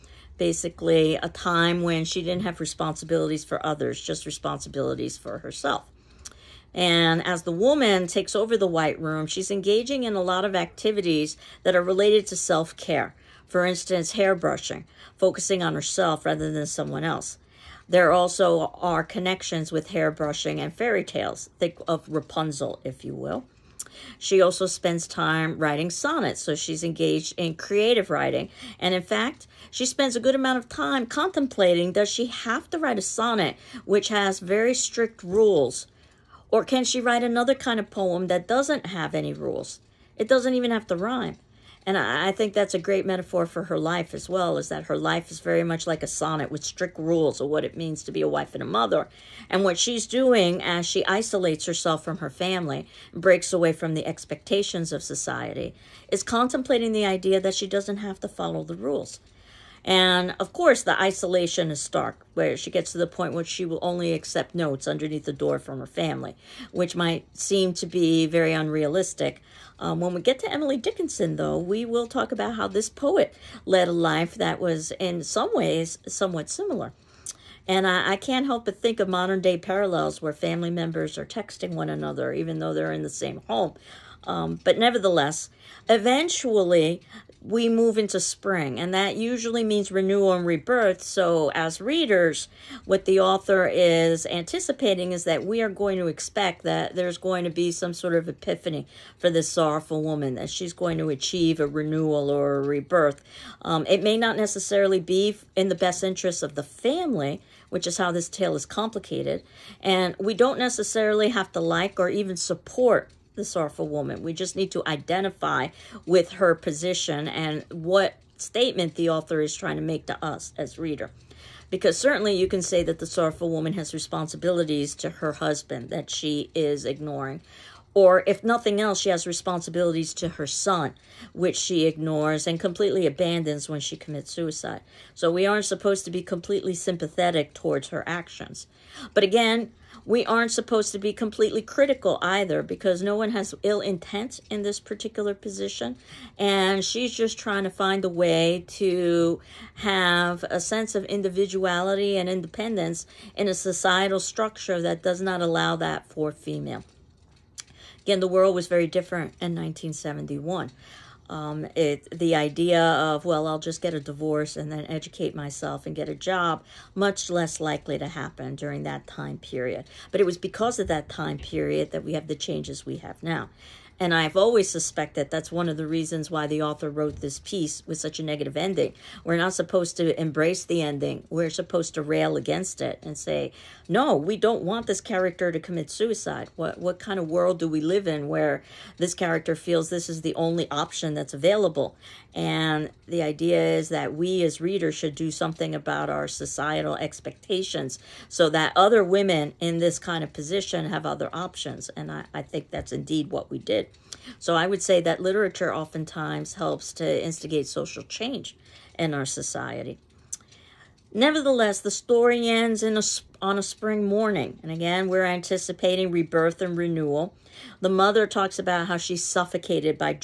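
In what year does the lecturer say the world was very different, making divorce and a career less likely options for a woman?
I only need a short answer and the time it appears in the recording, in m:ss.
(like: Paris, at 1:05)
1971, at 2:39.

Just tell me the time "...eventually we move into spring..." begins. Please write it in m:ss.
1:25.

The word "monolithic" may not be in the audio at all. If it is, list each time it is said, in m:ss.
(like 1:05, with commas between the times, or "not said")
not said.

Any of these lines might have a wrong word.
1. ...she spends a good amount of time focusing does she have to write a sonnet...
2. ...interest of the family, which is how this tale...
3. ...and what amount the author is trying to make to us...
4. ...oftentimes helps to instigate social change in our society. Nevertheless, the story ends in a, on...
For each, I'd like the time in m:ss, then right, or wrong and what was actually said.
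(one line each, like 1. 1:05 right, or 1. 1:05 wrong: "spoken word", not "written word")
1. 0:29 wrong: "contemplating", not "focusing"
2. 1:46 right
3. 1:57 wrong: "statement", not "amount"
4. 3:25 right.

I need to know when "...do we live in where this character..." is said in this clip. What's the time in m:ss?
3:07.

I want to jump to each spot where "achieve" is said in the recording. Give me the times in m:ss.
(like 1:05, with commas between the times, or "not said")
1:41.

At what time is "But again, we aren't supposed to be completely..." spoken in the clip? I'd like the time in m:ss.
2:19.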